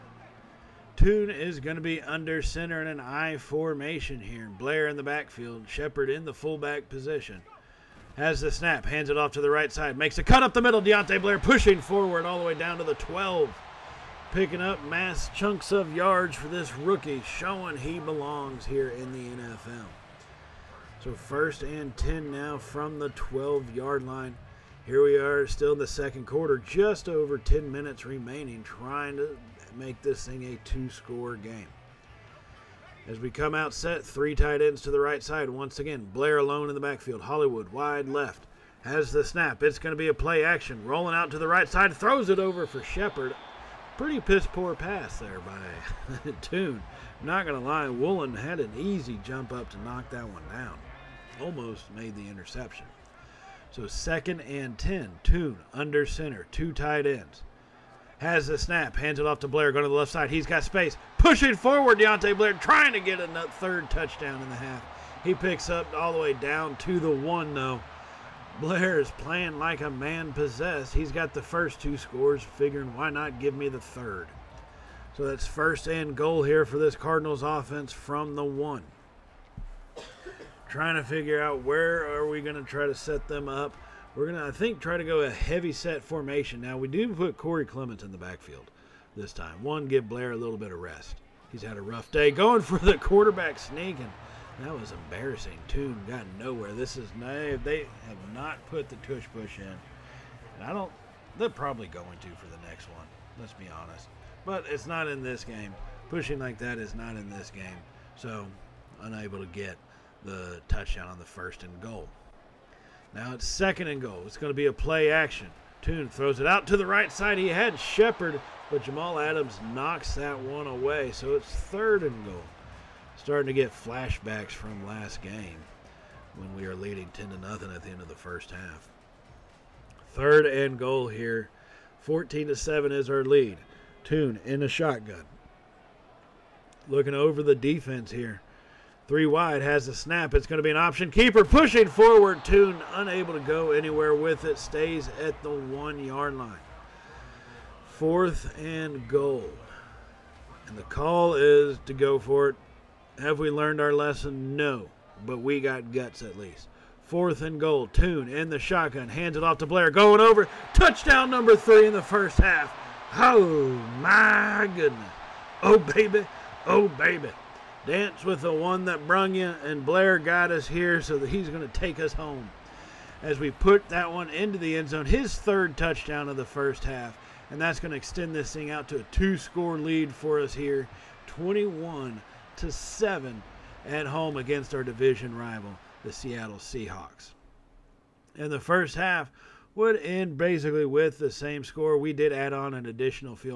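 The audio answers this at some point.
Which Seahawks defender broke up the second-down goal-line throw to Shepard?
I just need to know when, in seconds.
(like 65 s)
118 s.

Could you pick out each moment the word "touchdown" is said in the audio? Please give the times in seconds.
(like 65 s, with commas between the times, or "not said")
63 s, 110 s, 160 s, 175 s.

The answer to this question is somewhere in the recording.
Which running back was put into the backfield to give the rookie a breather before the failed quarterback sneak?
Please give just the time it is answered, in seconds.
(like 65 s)
87 s.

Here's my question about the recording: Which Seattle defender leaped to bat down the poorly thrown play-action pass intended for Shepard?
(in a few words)
Woolen.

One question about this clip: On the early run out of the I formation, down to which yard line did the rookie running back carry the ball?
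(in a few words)
12.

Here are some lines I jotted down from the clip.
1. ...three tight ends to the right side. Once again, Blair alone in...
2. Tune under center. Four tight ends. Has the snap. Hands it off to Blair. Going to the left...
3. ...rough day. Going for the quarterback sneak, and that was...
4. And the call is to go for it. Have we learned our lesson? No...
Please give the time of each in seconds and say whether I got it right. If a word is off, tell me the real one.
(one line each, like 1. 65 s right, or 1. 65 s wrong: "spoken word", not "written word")
1. 34 s right
2. 55 s wrong: "Two", not "Four"
3. 91 s right
4. 150 s right.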